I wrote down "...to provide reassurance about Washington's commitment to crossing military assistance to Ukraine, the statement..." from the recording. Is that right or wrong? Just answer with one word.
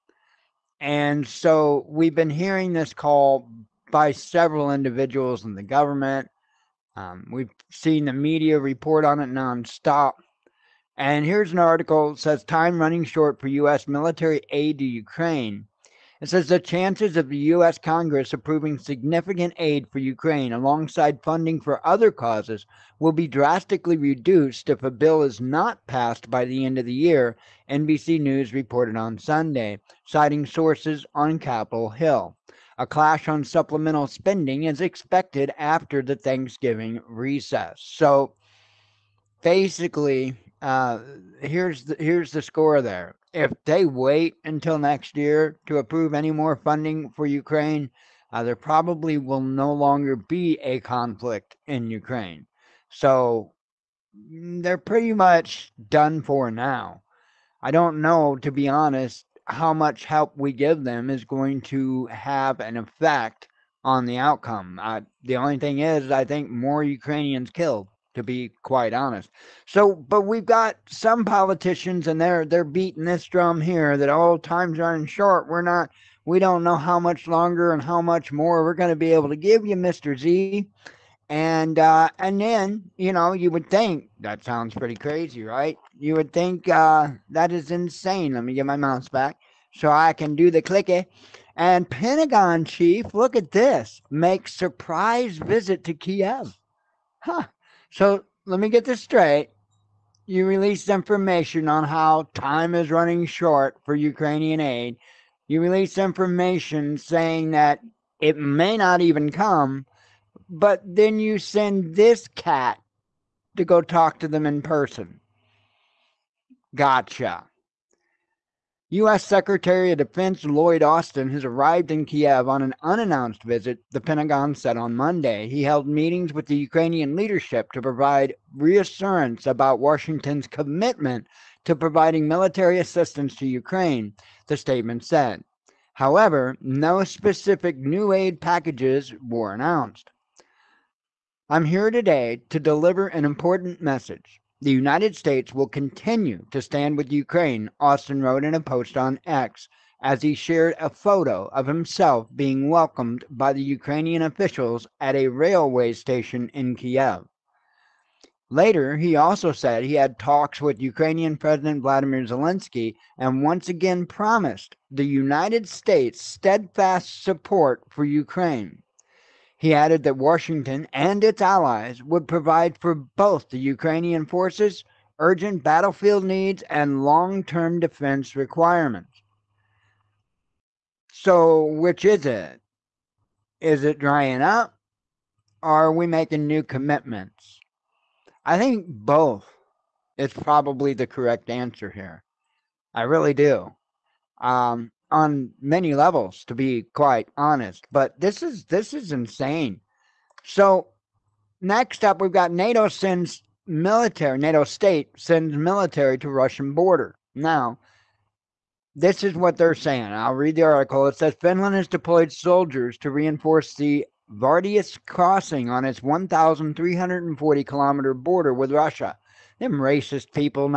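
wrong.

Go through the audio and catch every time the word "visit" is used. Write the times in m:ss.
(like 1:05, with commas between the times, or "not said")
1:35, 2:03.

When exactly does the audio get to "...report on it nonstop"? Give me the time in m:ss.
0:08.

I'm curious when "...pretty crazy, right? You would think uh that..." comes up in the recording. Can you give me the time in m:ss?
1:24.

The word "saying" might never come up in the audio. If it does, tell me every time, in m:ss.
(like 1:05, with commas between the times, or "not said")
1:46, 3:29.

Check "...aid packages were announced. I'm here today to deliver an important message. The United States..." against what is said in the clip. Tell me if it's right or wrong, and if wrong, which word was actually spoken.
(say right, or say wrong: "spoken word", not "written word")
right.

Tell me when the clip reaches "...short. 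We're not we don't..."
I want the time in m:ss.
1:15.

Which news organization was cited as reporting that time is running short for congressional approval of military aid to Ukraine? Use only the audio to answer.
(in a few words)
NBC News.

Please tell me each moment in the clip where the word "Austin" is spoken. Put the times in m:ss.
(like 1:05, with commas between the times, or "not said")
2:00, 2:27.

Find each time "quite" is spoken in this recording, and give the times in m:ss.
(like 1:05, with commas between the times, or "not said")
1:08, 3:16.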